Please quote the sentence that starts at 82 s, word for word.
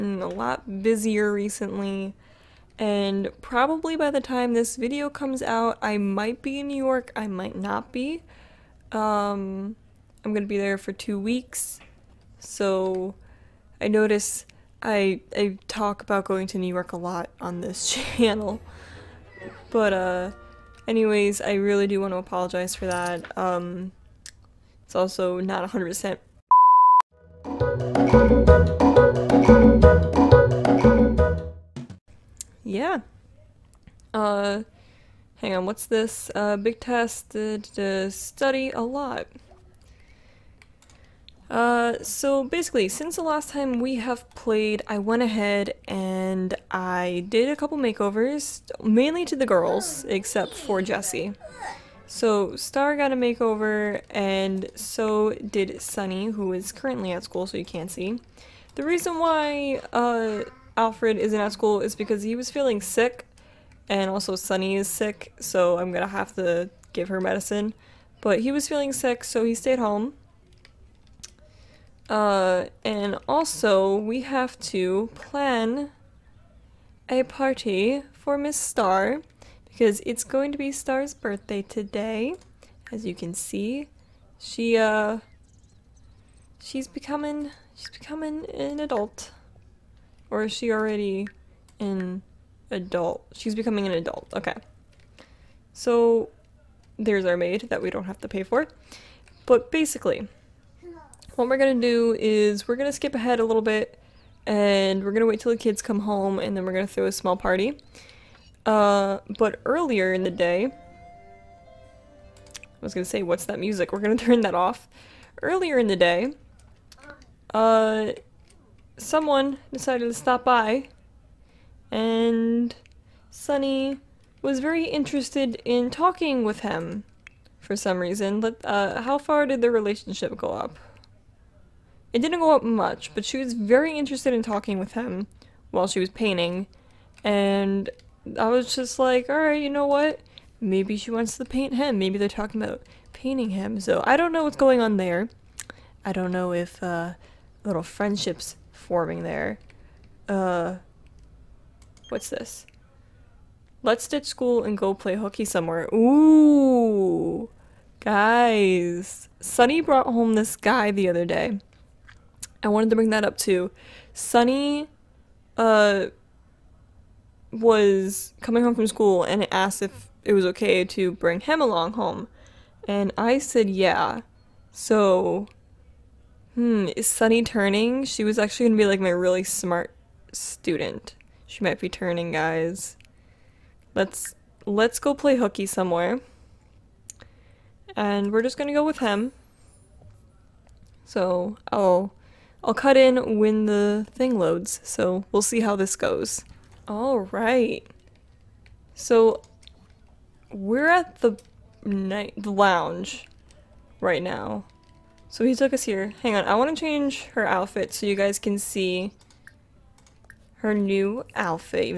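As you can see, she, uh, she's becoming, she's becoming an adult.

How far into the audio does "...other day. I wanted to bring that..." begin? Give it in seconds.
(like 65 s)
161 s.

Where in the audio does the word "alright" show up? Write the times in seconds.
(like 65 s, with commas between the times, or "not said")
139 s, 196 s.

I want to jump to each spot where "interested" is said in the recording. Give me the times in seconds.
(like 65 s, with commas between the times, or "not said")
124 s, 133 s.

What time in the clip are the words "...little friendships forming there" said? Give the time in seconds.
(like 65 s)
147 s.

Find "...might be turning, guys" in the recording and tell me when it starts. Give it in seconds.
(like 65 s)
181 s.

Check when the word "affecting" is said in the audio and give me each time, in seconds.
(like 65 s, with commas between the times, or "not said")
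not said.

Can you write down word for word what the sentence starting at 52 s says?
So Star got a makeover, and so did Sunny, who is currently at school, so you can't see.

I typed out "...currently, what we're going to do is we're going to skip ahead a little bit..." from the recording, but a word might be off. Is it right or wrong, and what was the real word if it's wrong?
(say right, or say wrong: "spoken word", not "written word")
wrong: "basically", not "currently".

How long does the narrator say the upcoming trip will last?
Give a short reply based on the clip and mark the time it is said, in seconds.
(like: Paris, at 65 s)
2 weeks, at 10 s.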